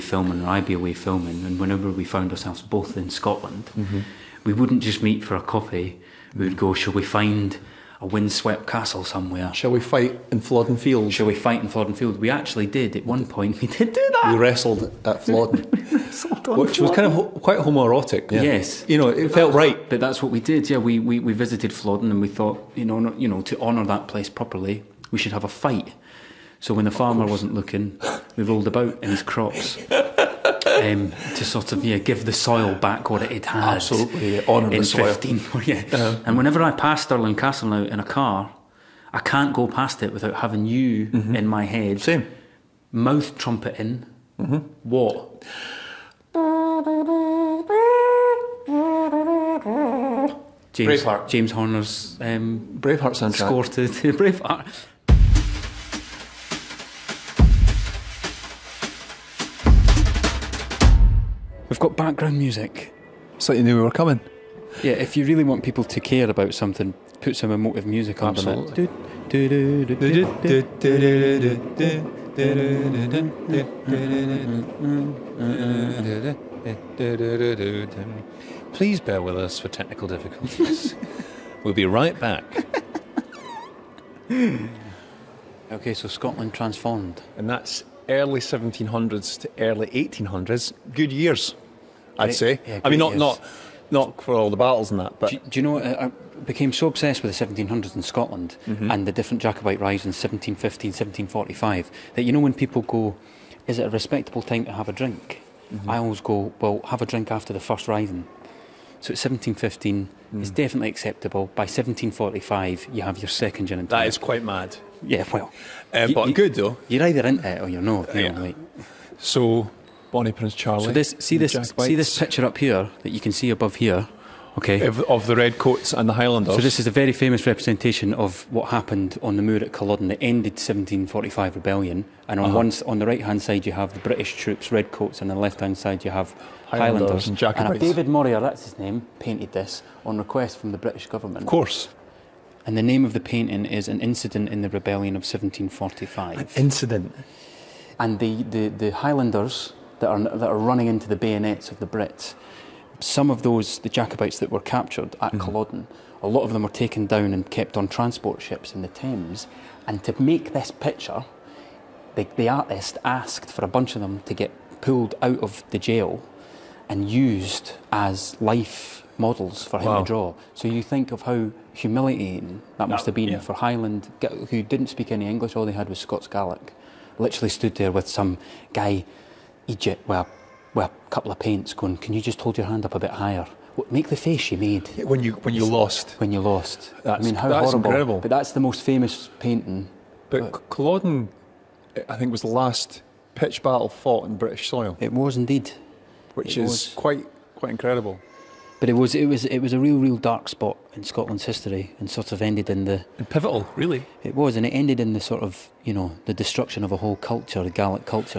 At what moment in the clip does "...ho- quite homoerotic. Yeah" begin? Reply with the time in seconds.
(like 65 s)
17 s.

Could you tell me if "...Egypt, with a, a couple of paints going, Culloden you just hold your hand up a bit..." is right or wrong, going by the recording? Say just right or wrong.
wrong.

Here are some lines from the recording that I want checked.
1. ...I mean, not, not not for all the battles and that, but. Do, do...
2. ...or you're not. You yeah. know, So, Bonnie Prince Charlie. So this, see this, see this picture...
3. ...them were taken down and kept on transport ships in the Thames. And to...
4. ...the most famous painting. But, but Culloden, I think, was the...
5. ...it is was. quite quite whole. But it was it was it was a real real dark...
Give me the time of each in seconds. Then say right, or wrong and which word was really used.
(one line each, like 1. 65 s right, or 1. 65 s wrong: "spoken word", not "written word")
1. 92 s right
2. 117 s right
3. 156 s right
4. 188 s right
5. 196 s wrong: "incredible", not "whole".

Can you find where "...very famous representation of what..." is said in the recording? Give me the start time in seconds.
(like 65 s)
126 s.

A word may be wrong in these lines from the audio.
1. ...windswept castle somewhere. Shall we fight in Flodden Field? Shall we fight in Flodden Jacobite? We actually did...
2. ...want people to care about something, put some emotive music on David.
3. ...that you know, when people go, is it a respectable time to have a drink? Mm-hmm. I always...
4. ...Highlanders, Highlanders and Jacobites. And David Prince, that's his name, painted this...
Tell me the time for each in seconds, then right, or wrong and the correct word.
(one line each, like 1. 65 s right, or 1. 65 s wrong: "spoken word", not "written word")
1. 8 s wrong: "Field", not "Jacobite"
2. 65 s wrong: "Absolutely", not "David"
3. 102 s right
4. 136 s wrong: "Morier", not "Prince".